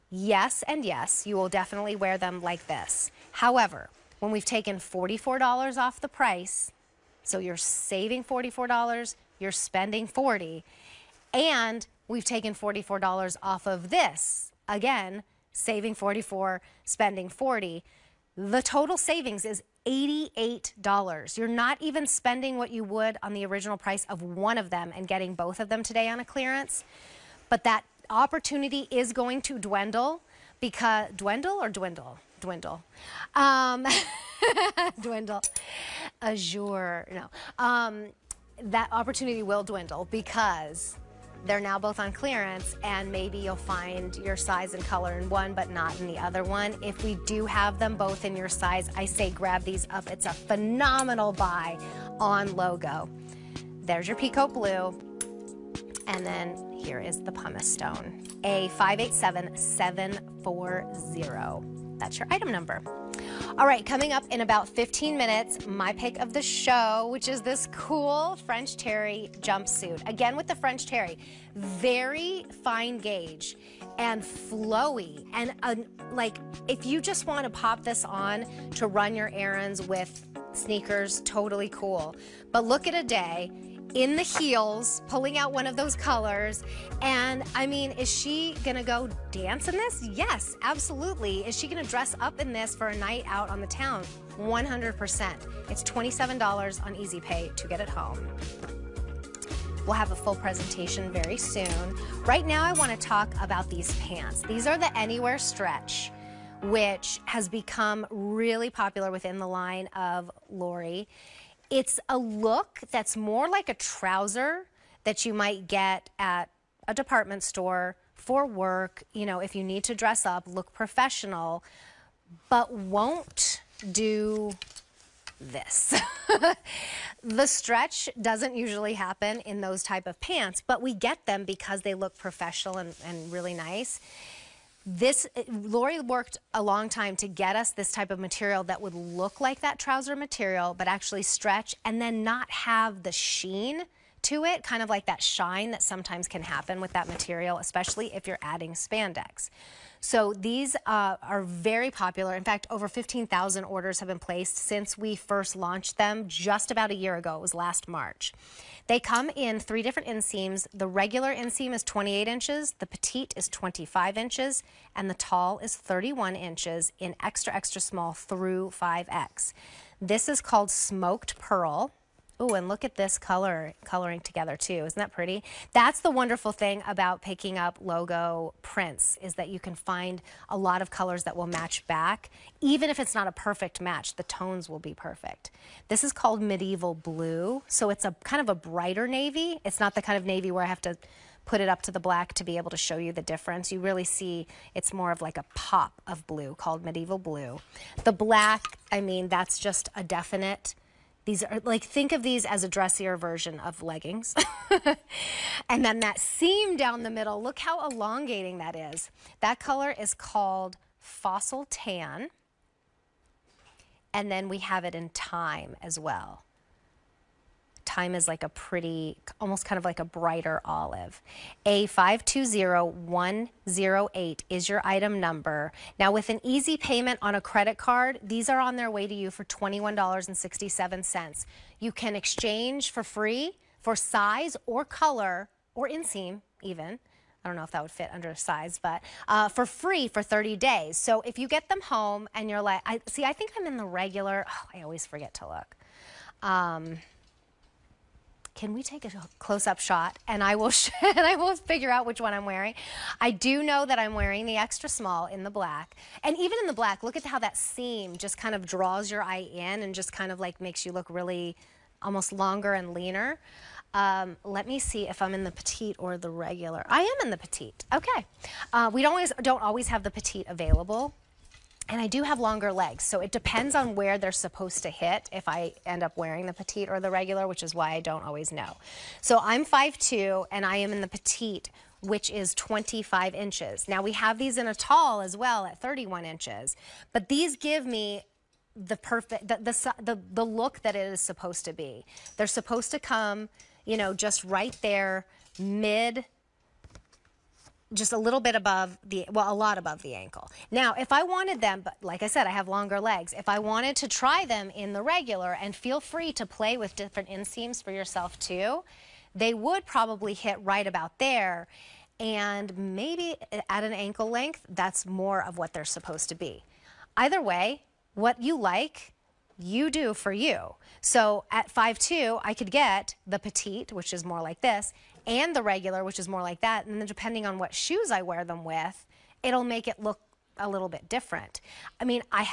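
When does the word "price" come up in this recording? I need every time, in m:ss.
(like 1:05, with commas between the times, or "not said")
0:06, 0:23.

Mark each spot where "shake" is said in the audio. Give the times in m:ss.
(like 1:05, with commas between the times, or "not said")
not said.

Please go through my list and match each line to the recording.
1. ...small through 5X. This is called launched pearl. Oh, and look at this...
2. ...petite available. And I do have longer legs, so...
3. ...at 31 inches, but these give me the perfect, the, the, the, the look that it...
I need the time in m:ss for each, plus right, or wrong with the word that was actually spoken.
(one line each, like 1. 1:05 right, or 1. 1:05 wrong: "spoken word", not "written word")
1. 2:47 wrong: "smoked", not "launched"
2. 4:30 right
3. 4:45 right.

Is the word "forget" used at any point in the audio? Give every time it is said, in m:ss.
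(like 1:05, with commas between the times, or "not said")
4:05.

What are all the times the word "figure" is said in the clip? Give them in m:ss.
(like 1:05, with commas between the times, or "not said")
4:11.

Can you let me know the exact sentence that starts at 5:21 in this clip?
So at 5'2", I could get the petite, which is more like this, and the regular, which is more like that.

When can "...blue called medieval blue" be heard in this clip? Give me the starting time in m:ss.
3:16.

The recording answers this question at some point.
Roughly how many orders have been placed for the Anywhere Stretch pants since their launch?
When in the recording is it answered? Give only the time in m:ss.
2:32.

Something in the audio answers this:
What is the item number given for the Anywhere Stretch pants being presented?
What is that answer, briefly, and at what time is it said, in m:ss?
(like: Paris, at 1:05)
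A520108, at 3:41.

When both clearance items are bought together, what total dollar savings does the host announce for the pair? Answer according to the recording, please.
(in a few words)
$88.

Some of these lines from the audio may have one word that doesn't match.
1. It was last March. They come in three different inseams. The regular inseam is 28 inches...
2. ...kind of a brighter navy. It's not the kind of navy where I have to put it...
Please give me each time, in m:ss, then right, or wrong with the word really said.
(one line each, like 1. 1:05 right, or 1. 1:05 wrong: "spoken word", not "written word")
1. 2:37 right
2. 3:08 right.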